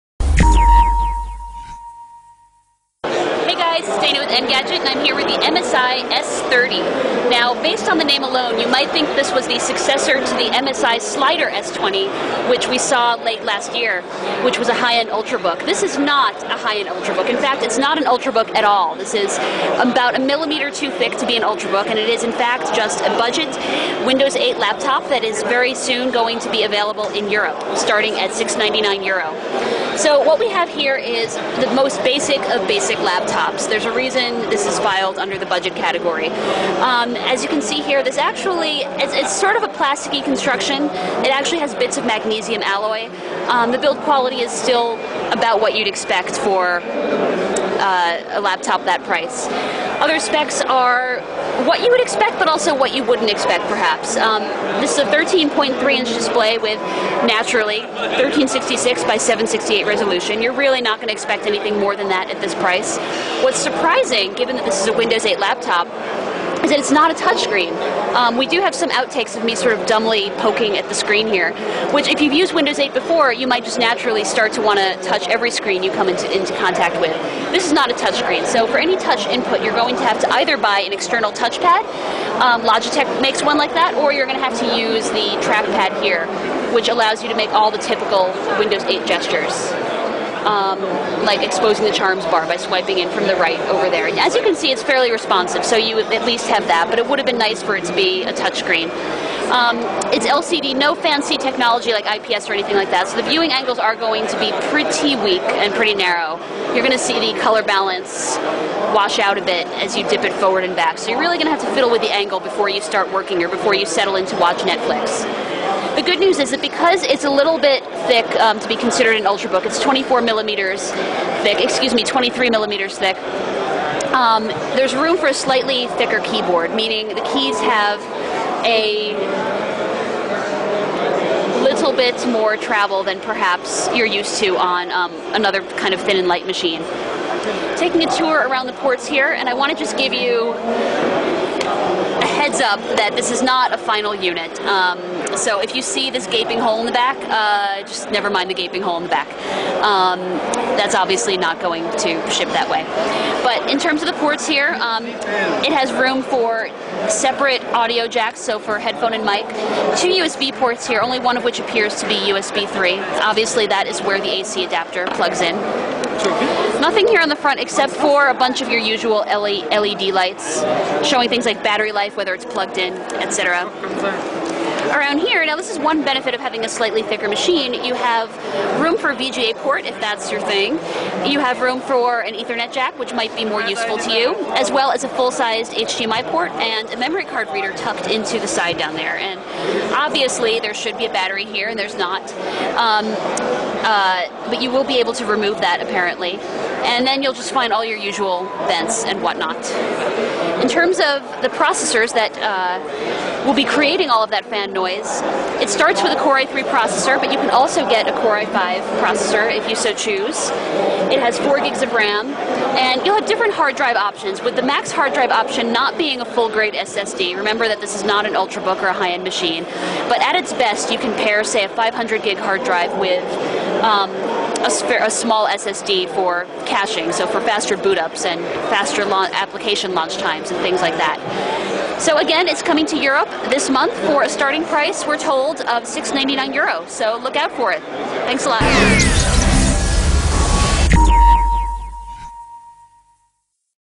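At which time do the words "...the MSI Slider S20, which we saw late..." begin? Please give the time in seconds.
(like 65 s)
10 s.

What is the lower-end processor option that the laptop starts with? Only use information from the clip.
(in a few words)
Core i3.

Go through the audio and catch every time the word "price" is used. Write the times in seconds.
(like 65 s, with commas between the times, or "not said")
49 s, 62 s, 234 s.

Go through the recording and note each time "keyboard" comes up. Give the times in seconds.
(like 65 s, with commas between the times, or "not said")
126 s.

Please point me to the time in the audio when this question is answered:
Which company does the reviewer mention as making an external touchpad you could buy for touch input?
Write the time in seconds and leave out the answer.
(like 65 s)
82 s.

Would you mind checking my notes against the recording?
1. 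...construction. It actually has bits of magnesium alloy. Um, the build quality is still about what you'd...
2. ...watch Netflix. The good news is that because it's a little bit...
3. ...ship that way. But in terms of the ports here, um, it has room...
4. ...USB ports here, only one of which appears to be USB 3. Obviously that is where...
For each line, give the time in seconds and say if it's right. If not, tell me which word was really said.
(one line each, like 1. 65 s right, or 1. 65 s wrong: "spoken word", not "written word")
1. 40 s right
2. 114 s right
3. 152 s right
4. 160 s right.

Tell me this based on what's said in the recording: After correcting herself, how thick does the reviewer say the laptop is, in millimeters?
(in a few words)
23 millimeters.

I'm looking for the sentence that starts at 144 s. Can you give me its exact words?
Um, so if you see this gaping hole in the back, uh, just never mind the gaping hole in the back.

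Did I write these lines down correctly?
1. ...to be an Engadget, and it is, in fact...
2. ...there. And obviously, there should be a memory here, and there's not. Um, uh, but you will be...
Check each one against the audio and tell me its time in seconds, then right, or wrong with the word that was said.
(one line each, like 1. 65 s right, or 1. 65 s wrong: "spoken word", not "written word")
1. 21 s wrong: "Ultrabook", not "Engadget"
2. 188 s wrong: "battery", not "memory".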